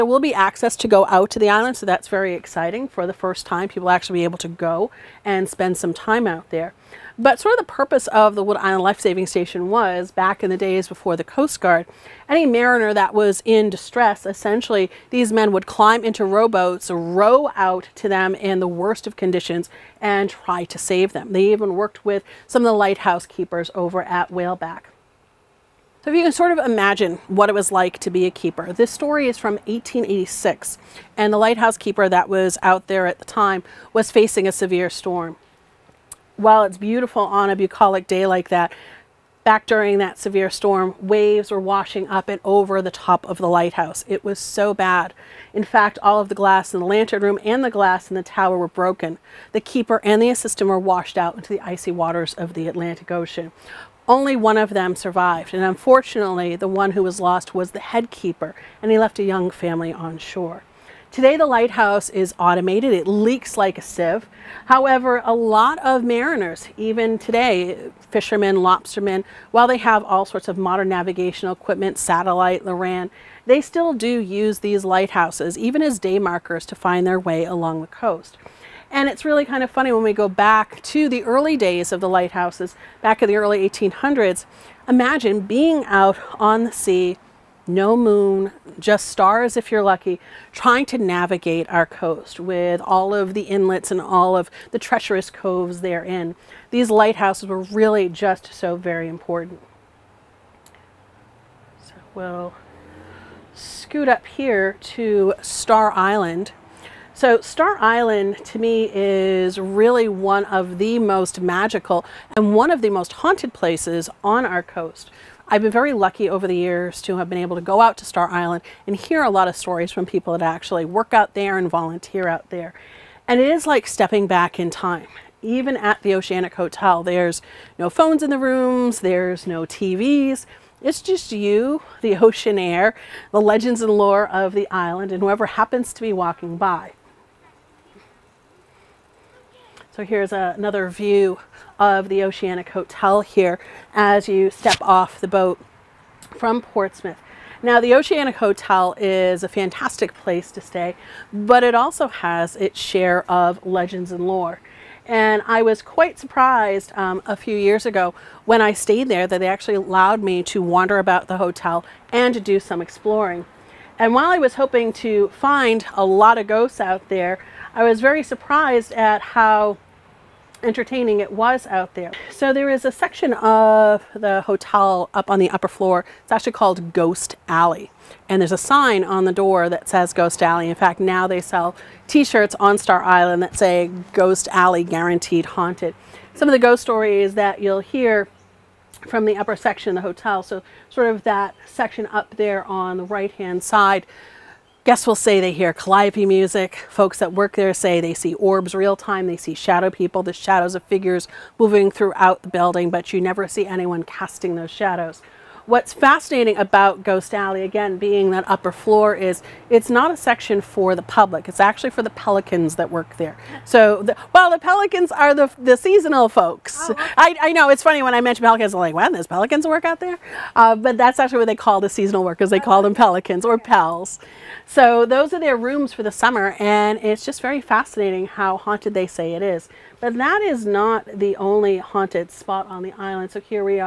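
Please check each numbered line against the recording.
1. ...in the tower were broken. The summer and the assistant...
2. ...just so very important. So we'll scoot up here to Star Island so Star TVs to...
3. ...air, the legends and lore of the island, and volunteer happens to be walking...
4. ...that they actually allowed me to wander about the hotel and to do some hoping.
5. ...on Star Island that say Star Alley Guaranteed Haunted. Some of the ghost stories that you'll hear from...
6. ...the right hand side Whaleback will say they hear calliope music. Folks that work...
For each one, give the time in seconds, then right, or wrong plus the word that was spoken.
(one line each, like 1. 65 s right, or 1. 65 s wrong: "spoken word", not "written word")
1. 48 s wrong: "keeper", not "summer"
2. 98 s wrong: "Island", not "TVs"
3. 132 s wrong: "whoever", not "volunteer"
4. 159 s wrong: "exploring", not "hoping"
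5. 182 s wrong: "Ghost", not "Star"
6. 192 s wrong: "Guests", not "Whaleback".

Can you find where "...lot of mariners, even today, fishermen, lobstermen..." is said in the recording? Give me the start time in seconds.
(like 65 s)
65 s.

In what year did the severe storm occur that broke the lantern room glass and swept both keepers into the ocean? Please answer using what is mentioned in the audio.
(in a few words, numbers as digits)
1886.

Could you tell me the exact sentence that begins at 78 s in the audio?
And it's really kind of funny when we go back to the early days of the lighthouses, back in the early 1800s.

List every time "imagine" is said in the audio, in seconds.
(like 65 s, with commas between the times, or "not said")
26 s, 84 s.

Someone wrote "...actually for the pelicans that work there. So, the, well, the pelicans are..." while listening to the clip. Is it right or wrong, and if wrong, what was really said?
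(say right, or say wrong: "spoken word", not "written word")
right.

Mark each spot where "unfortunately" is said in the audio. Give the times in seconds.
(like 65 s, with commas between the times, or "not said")
55 s.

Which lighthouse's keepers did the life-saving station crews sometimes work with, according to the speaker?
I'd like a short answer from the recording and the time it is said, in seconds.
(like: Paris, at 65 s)
Whaleback, at 24 s.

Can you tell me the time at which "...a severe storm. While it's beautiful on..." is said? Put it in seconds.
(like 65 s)
34 s.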